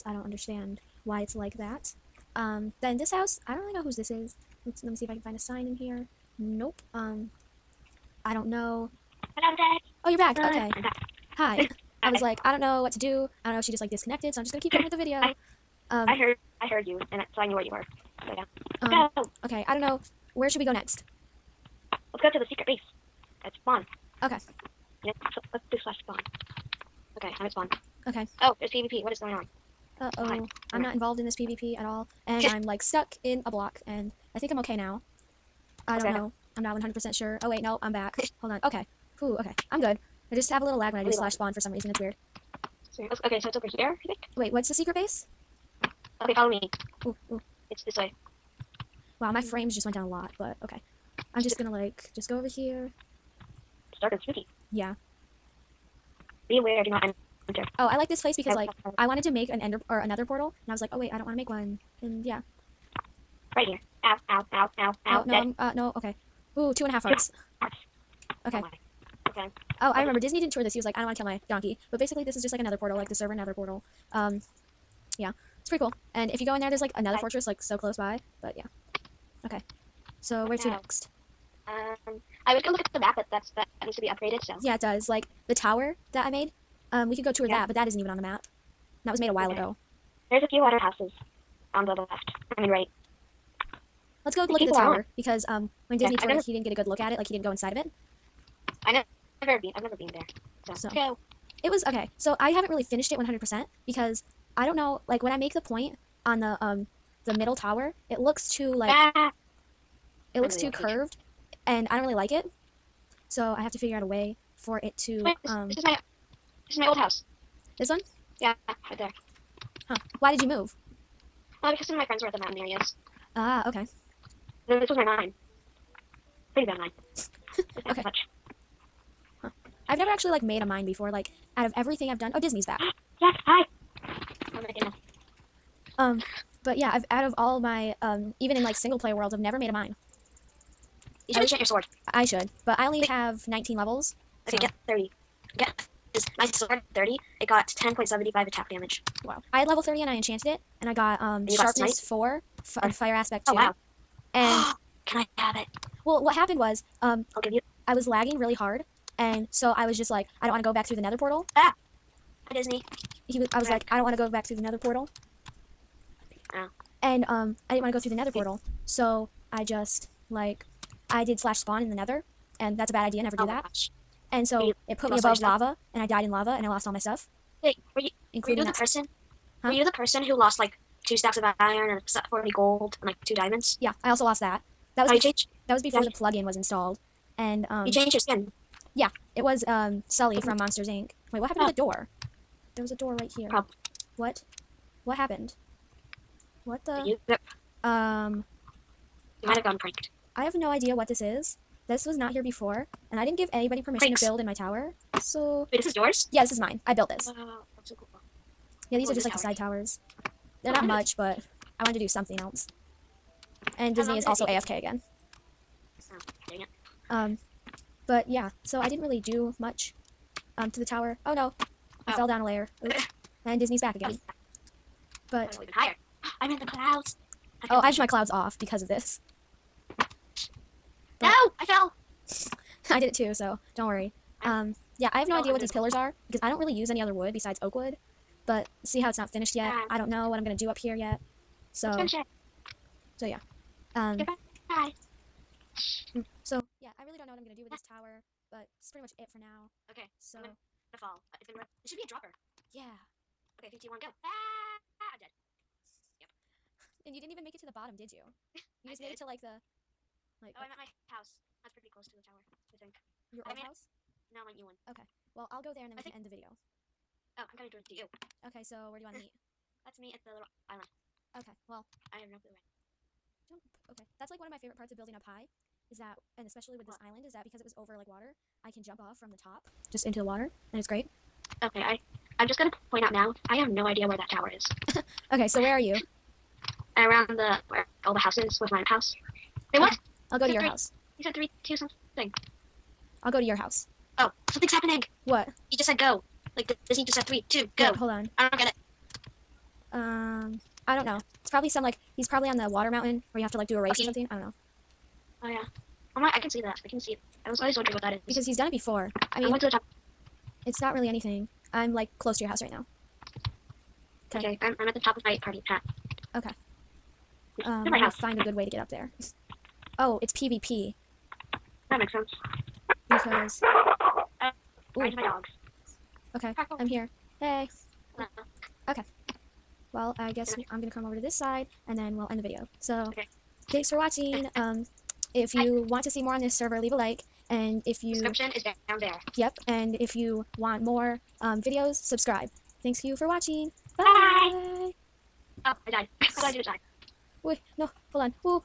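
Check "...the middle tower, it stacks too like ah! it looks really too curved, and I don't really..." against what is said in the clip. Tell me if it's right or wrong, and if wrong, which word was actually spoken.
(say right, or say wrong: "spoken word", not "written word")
wrong: "looks", not "stacks".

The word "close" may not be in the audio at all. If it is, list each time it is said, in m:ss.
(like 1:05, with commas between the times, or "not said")
1:17, 4:21, 5:12.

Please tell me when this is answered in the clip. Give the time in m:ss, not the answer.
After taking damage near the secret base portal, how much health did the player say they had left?
1:06.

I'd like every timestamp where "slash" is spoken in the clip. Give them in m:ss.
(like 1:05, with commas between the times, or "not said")
0:25, 0:41, 2:51.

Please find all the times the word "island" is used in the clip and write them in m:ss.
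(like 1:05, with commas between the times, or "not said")
4:30, 4:37.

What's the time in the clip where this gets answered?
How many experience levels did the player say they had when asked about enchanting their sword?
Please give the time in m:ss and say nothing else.
2:23.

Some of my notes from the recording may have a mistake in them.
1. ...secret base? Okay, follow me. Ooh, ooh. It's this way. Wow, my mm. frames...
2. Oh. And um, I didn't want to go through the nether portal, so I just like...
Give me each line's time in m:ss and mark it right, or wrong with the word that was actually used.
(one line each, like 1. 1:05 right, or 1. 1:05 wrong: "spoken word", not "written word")
1. 0:44 right
2. 2:46 right.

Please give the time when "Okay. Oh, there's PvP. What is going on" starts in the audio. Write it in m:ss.
0:28.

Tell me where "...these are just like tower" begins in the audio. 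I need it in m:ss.
3:28.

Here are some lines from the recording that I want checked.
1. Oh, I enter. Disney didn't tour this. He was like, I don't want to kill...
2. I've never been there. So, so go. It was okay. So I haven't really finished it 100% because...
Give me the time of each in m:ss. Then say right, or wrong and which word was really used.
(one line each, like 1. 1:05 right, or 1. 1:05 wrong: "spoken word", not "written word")
1. 1:09 wrong: "remember", not "enter"
2. 1:39 right.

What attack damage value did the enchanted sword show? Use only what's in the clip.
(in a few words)
10.75.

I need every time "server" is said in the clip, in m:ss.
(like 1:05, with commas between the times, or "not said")
1:13, 5:36.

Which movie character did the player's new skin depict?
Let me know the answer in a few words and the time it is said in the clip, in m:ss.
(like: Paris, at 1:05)
Sully, at 3:10.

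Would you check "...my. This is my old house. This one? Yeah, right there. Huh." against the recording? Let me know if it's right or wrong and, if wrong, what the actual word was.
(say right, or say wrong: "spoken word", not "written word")
right.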